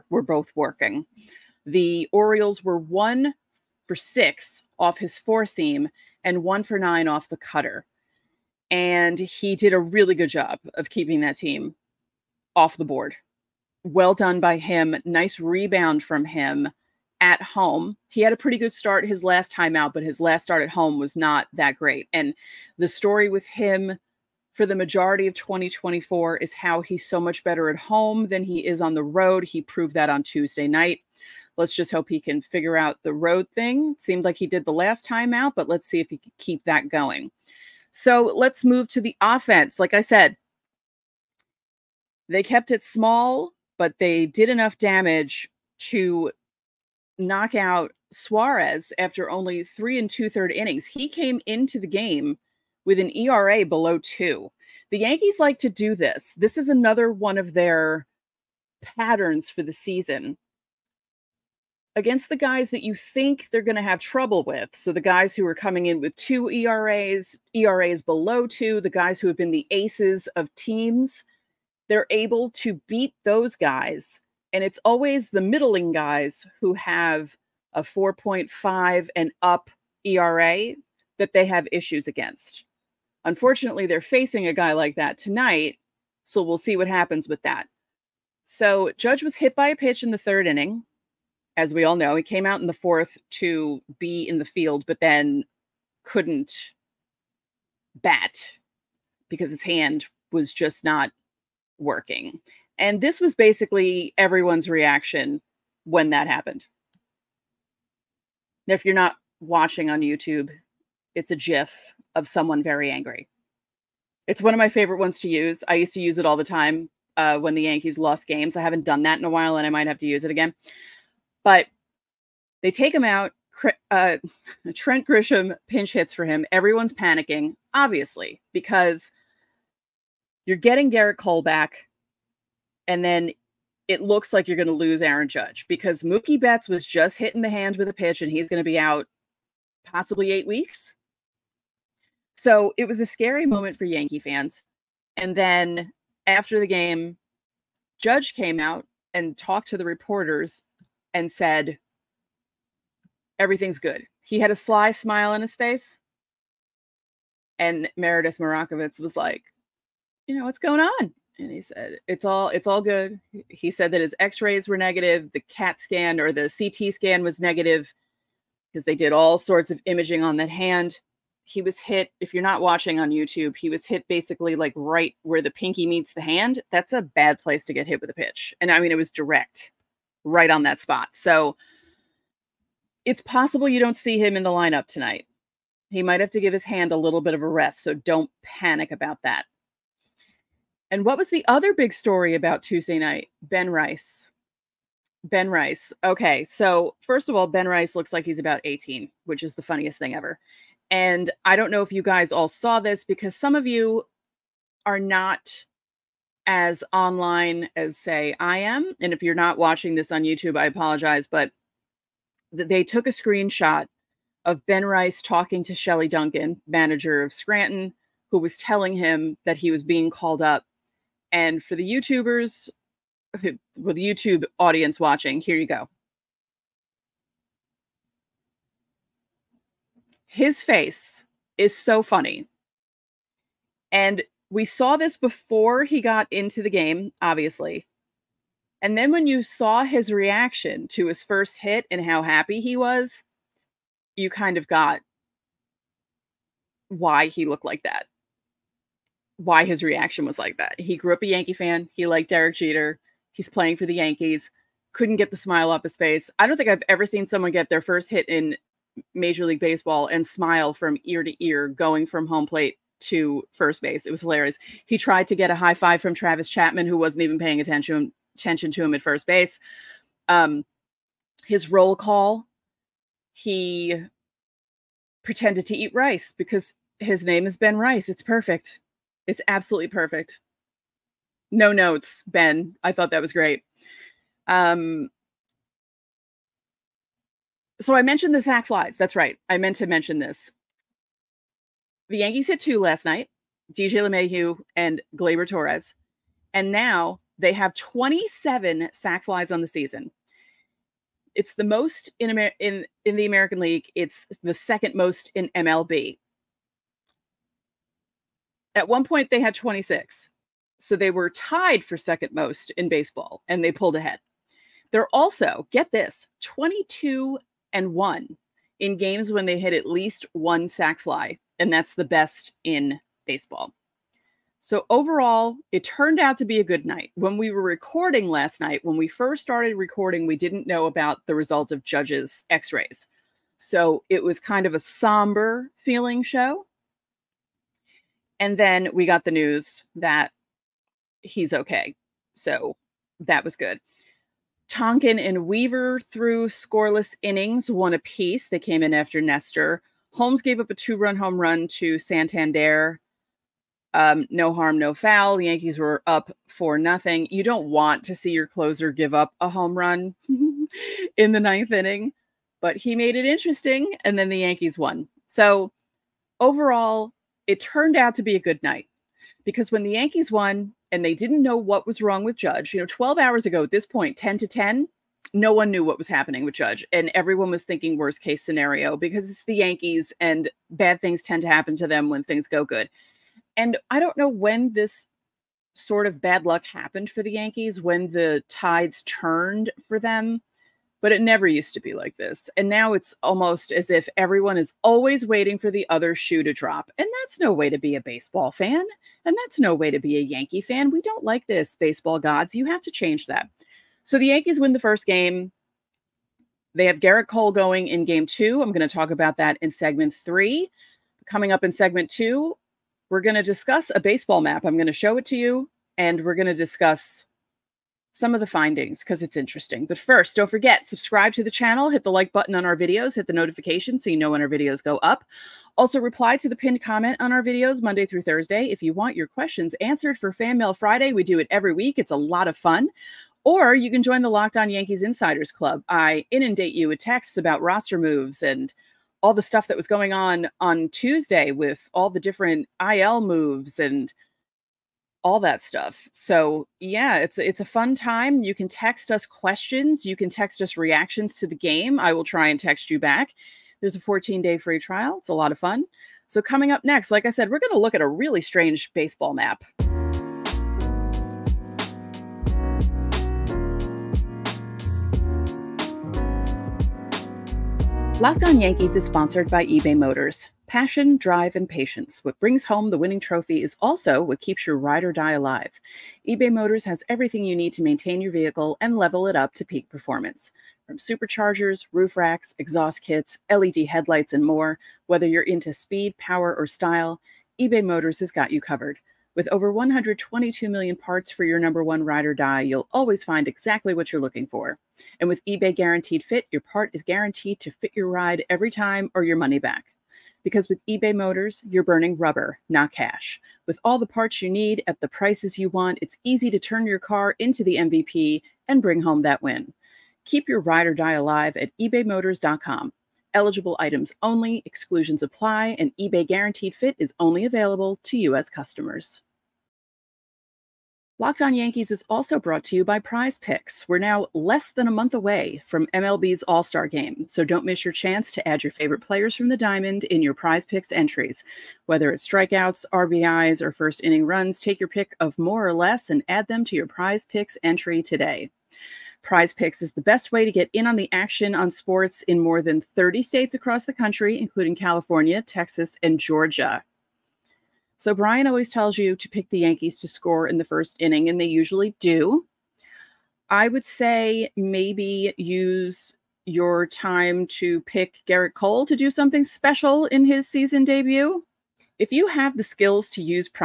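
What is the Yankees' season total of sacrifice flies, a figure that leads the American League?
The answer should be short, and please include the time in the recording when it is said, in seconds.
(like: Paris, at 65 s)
27, at 297 s.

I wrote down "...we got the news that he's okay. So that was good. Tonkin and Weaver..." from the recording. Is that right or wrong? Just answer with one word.
right.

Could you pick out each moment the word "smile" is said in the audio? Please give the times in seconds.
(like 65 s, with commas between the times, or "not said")
154 s, 255 s, 260 s.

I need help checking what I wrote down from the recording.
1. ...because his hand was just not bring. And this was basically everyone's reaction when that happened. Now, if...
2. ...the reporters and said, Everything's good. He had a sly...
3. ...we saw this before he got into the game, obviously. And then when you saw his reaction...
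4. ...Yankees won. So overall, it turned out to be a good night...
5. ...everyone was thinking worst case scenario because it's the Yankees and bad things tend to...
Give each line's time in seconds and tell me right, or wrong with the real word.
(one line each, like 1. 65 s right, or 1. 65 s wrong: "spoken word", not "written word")
1. 99 s wrong: "working", not "bring"
2. 149 s right
3. 234 s right
4. 364 s right
5. 377 s right.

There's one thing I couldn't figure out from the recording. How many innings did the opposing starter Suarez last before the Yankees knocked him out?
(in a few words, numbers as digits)
3 2/3.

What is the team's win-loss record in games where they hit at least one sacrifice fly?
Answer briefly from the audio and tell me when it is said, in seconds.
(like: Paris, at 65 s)
22-1, at 316 s.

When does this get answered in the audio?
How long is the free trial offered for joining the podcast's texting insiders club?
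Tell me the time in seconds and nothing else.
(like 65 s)
453 s.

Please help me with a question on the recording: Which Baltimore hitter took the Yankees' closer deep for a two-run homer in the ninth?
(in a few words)
Santander.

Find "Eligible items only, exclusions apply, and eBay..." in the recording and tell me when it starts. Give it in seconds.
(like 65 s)
513 s.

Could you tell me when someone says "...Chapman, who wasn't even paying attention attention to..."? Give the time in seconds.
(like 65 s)
266 s.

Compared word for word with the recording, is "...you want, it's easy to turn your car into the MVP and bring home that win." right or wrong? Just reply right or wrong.
right.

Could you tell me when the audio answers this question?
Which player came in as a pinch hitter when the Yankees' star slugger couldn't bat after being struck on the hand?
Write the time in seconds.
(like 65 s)
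124 s.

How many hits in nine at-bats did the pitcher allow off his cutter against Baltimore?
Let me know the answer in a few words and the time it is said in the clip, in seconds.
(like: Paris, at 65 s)
1, at 6 s.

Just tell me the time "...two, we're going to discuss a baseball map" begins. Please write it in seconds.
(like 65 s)
412 s.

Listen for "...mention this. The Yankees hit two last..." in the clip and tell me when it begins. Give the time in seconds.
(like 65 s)
289 s.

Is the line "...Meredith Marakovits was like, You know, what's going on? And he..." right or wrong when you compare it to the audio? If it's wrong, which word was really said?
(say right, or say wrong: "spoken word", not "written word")
right.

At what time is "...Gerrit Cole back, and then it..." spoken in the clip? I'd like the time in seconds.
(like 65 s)
130 s.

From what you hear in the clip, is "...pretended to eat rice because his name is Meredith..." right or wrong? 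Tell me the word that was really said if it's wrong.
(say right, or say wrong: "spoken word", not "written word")
wrong: "Ben", not "Meredith".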